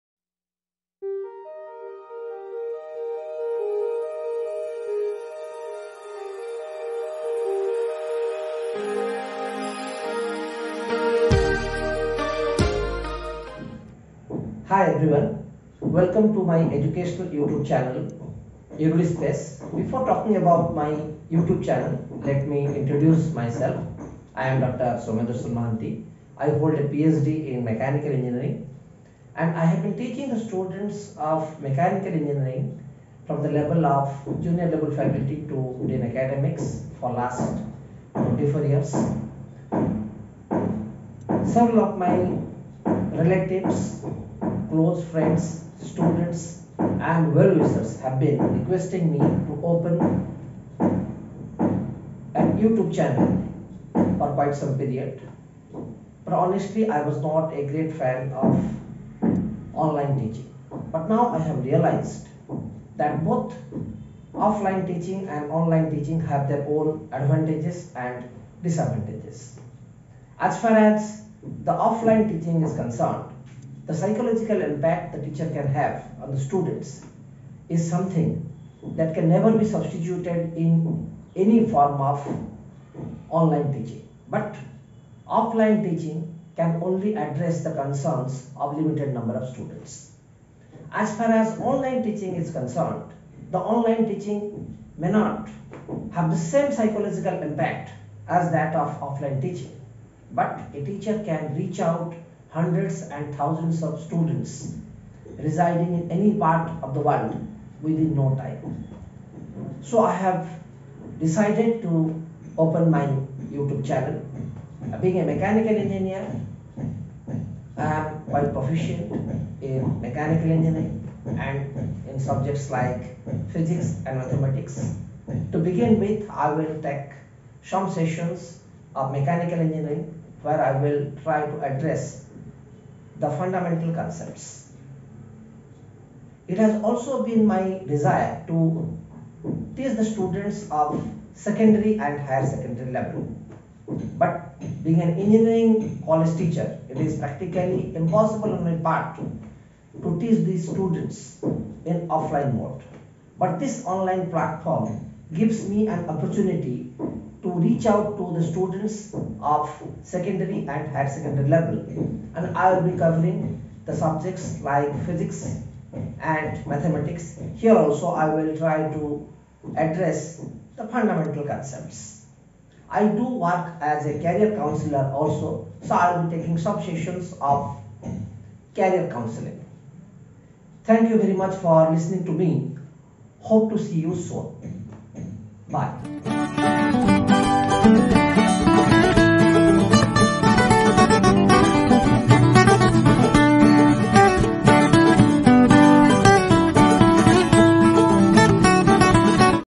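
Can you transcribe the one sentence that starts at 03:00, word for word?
Thank you very much for listening to me.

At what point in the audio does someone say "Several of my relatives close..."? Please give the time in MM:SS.
00:41.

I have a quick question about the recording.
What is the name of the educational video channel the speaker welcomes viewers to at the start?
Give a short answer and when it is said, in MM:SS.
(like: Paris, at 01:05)
ErudiSpace, at 00:18.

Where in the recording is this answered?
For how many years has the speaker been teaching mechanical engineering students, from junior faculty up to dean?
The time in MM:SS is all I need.
00:38.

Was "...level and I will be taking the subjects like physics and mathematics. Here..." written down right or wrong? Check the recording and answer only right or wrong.
wrong.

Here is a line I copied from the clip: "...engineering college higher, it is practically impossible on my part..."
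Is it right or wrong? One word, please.
wrong.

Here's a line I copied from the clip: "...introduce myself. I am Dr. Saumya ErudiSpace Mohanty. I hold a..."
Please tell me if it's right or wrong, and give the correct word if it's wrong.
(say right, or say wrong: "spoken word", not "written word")
wrong: "Darsan", not "ErudiSpace".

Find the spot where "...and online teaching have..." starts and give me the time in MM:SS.
01:05.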